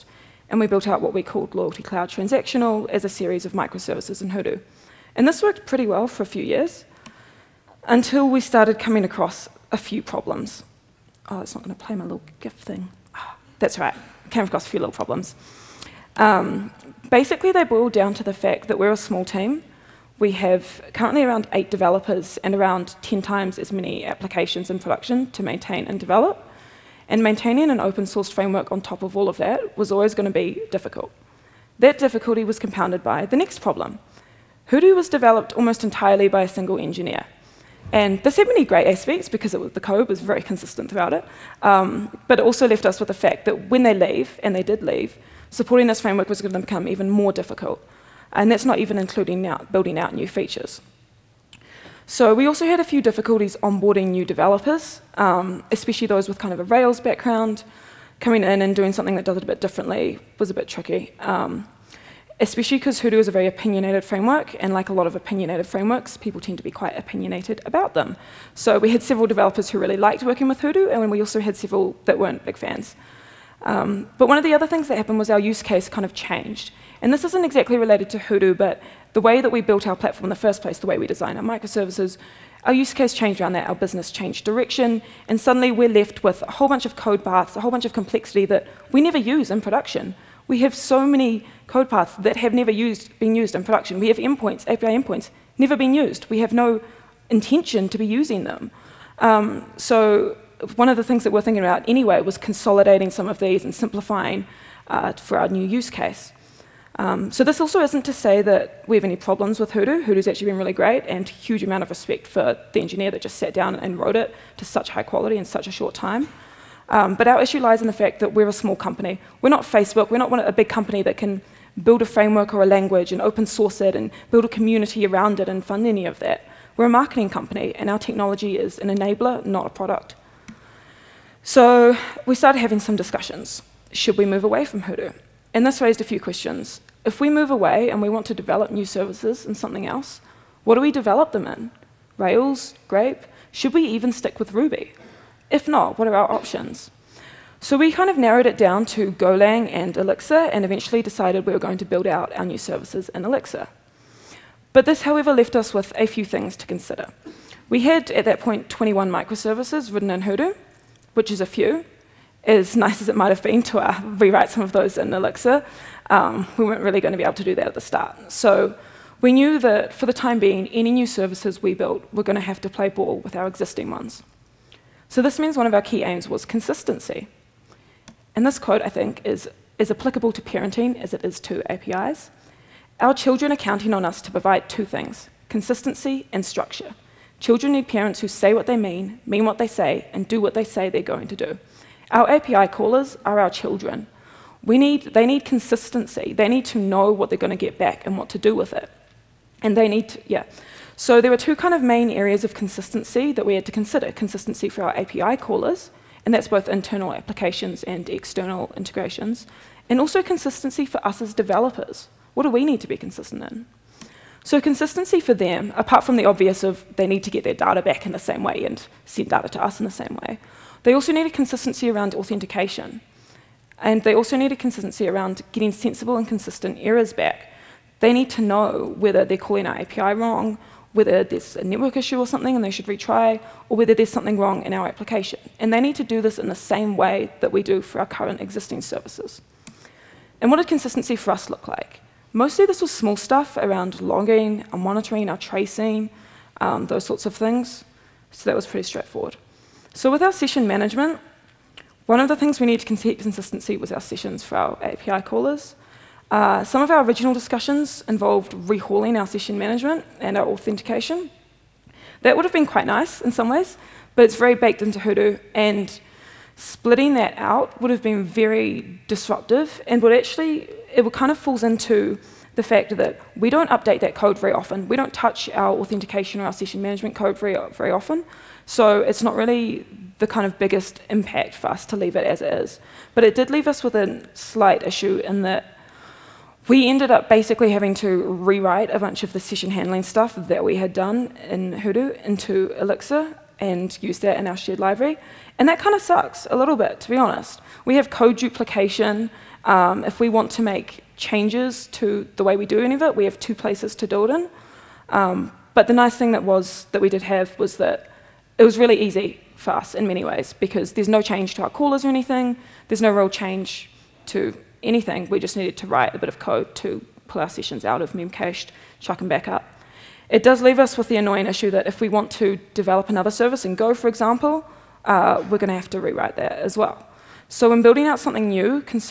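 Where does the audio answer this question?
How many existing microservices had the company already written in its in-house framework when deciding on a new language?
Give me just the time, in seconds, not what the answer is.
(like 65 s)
158 s.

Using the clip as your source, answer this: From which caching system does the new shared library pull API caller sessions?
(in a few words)
memcached.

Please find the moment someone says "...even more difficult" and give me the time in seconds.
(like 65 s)
46 s.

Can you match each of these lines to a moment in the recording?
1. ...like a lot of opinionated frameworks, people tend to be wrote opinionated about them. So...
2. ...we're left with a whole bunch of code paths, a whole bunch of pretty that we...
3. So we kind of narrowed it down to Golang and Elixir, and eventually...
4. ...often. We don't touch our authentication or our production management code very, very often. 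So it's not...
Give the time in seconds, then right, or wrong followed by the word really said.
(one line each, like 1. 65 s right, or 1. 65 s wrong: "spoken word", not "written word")
1. 64 s wrong: "quite", not "wrote"
2. 85 s wrong: "complexity", not "pretty"
3. 147 s right
4. 274 s wrong: "session", not "production".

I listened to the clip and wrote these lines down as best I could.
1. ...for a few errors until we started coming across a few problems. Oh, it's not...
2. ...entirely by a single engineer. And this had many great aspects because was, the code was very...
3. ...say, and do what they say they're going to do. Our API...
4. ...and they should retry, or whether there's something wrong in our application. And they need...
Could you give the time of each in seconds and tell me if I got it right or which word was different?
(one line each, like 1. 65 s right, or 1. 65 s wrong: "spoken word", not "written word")
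1. 6 s wrong: "years", not "errors"
2. 35 s right
3. 189 s right
4. 232 s right.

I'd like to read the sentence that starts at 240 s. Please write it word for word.
And what did consistency for us look like?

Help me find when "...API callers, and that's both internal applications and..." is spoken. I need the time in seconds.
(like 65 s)
204 s.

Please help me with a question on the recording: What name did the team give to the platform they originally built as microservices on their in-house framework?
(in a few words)
Loyalty Cloud Transactional.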